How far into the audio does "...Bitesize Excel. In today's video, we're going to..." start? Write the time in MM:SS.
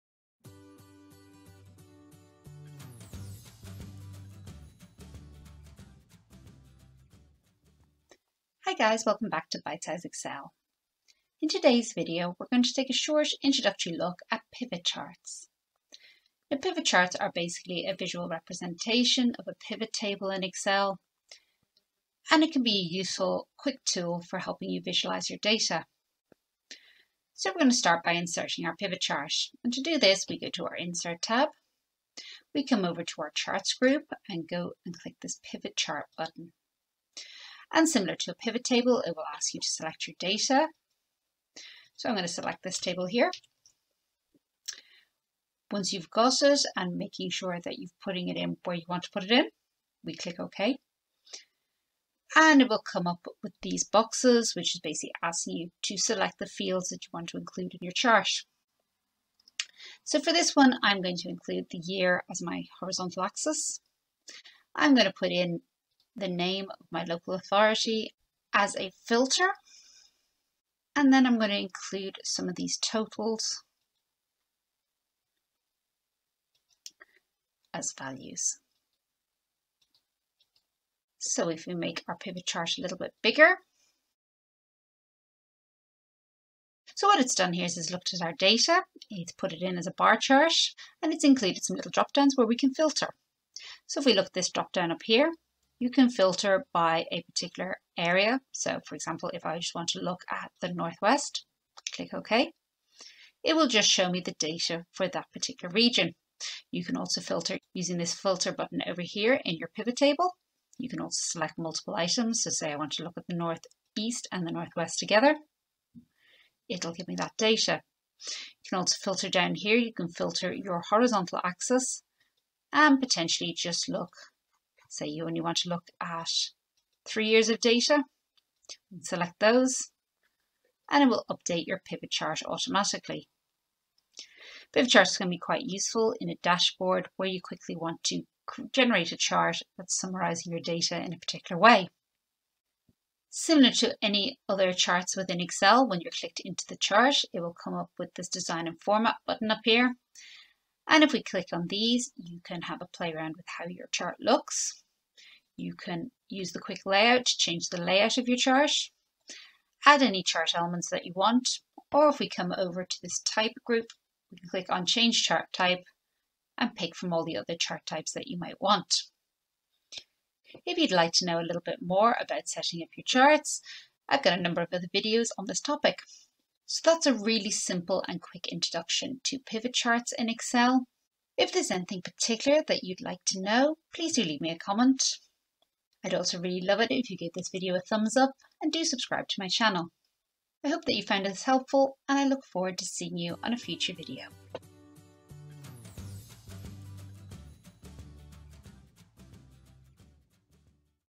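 00:09.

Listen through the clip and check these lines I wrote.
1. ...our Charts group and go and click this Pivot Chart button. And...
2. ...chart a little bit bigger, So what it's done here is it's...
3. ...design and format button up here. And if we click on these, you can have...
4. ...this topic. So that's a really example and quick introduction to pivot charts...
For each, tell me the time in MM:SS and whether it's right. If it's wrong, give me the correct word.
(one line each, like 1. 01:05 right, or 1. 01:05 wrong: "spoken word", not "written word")
1. 00:33 right
2. 01:22 right
3. 02:28 right
4. 02:55 wrong: "simple", not "example".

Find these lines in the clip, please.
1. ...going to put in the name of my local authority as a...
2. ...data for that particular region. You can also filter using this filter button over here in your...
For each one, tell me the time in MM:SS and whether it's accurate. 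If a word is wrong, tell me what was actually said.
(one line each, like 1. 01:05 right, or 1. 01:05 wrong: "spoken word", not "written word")
1. 01:04 right
2. 01:44 right.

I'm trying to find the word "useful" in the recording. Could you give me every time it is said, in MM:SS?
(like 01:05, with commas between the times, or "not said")
00:22, 02:15.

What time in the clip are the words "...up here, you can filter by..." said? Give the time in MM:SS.
01:34.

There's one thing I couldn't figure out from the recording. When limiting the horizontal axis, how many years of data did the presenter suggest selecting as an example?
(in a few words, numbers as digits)
3.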